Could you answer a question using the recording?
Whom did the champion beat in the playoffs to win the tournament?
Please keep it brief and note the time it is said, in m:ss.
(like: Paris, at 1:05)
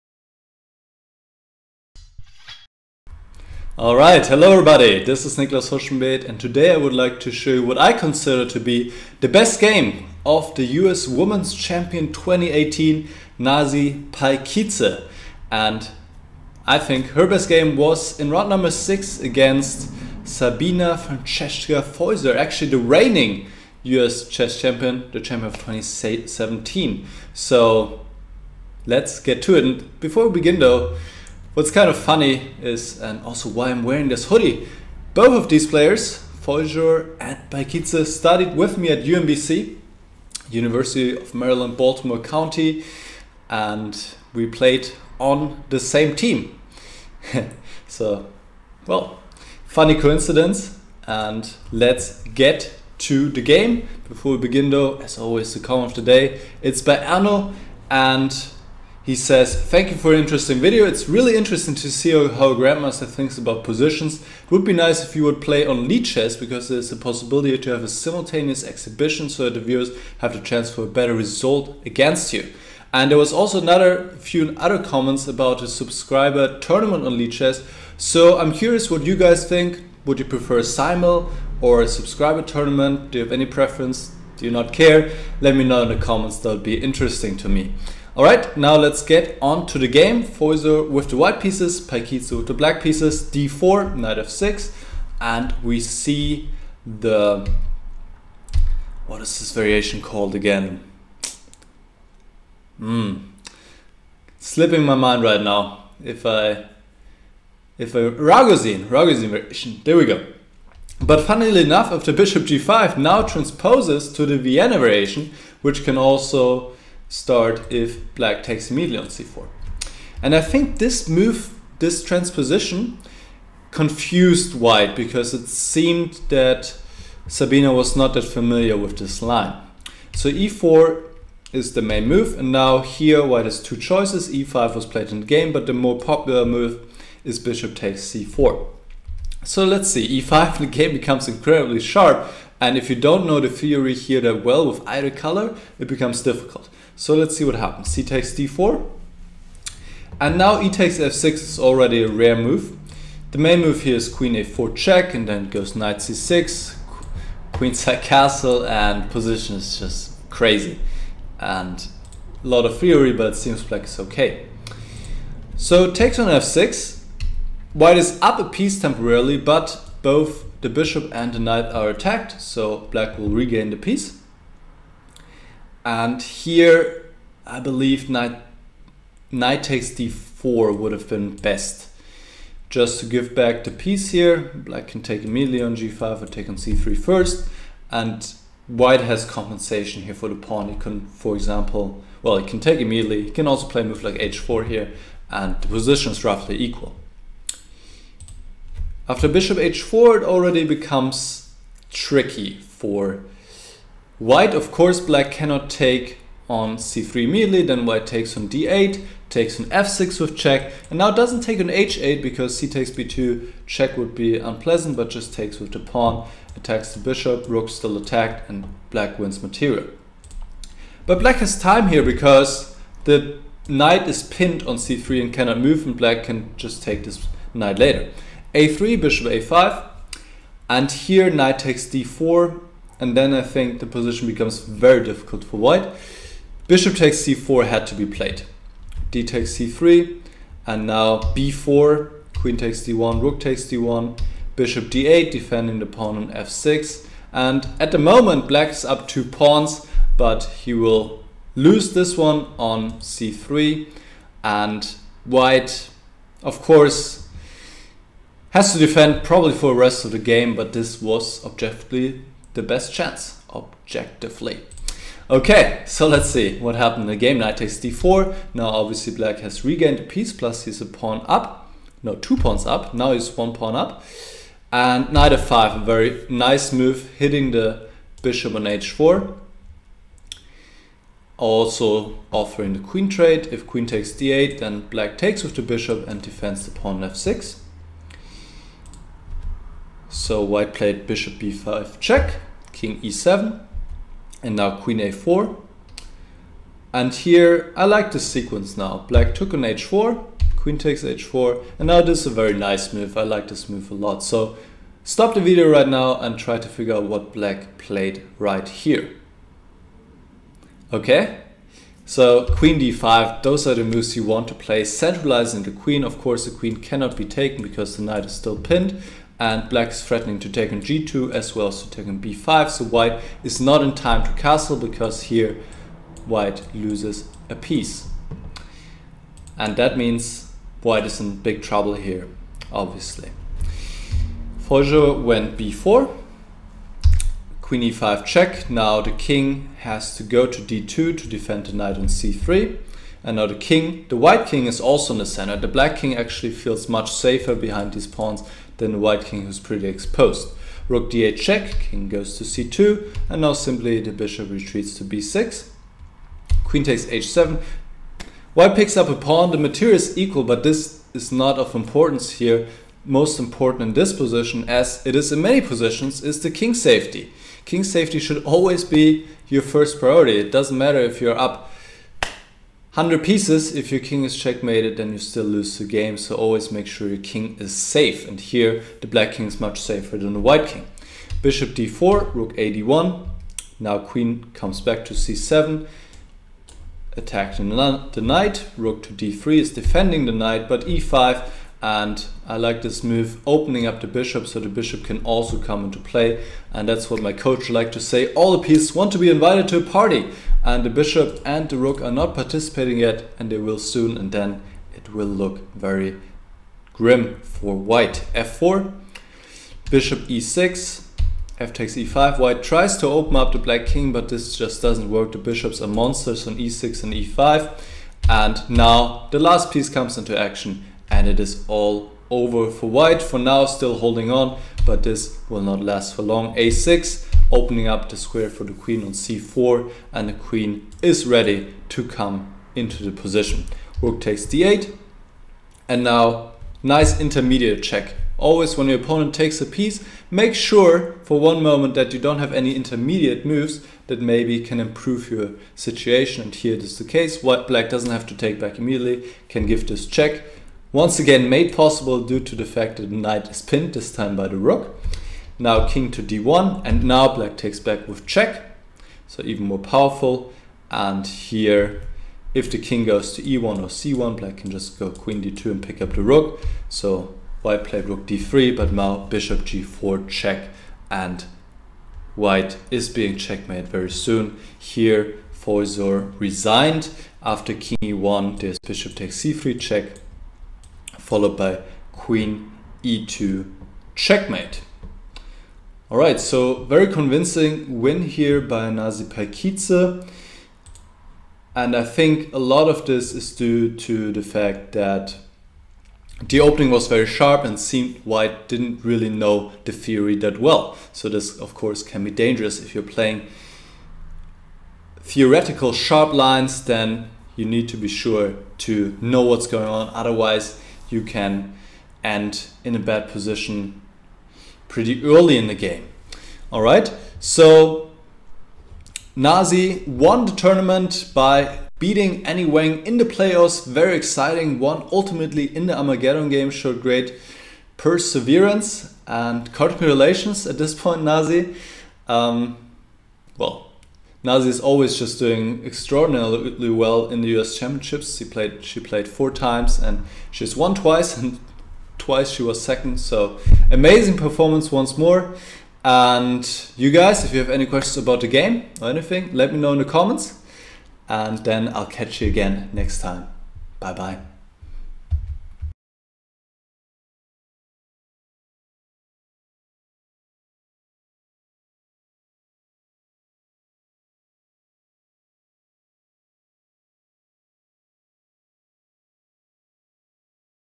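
Annie Wang, at 8:42.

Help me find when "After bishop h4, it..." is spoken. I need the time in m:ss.
3:19.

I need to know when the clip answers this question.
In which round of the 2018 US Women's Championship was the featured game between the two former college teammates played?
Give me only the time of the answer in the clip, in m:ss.
0:18.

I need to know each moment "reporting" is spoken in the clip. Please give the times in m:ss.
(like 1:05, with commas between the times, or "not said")
not said.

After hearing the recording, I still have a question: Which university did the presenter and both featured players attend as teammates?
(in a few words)
UMBC.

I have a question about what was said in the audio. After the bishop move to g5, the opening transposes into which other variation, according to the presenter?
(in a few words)
Vienna variation.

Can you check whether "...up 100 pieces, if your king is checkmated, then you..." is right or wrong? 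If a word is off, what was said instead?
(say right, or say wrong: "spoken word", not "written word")
right.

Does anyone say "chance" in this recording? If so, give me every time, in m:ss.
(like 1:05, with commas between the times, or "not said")
1:10, 4:22.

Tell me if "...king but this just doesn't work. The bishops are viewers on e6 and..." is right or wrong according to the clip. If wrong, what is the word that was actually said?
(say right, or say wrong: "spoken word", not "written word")
wrong: "monsters", not "viewers".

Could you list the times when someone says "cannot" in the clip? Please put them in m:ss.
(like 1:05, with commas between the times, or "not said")
3:25, 3:45, 5:16.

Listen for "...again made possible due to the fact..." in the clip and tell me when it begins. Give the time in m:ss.
7:31.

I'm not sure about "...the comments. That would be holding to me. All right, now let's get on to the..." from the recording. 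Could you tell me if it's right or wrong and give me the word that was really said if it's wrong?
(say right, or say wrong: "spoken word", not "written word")
wrong: "interesting", not "holding".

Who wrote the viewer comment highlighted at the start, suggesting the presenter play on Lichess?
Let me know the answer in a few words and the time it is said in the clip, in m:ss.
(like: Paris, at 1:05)
Arno, at 0:57.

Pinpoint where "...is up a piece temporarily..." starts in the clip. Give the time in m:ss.
2:47.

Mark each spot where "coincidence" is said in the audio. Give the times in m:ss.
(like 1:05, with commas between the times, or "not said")
0:49.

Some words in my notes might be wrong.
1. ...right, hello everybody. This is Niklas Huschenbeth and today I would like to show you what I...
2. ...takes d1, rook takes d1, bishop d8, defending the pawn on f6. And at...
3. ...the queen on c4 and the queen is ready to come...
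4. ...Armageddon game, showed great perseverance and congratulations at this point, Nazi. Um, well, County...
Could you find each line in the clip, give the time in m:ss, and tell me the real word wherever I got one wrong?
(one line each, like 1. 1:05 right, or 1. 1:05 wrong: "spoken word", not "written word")
1. 0:03 right
2. 4:02 right
3. 7:08 right
4. 8:45 wrong: "Nazi", not "County".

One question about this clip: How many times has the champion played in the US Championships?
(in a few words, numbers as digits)
4.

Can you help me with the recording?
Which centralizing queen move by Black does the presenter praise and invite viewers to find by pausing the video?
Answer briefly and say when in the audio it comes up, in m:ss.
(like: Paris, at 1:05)
queen d5, at 5:12.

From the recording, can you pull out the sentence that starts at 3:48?
a3, bishop a5, and here knight takes d4, and then I think the position becomes very difficult for white.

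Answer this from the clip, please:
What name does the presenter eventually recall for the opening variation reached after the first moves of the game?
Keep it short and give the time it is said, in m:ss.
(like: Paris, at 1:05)
Ragozin variation, at 1:48.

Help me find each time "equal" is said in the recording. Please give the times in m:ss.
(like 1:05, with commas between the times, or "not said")
3:16, 6:00.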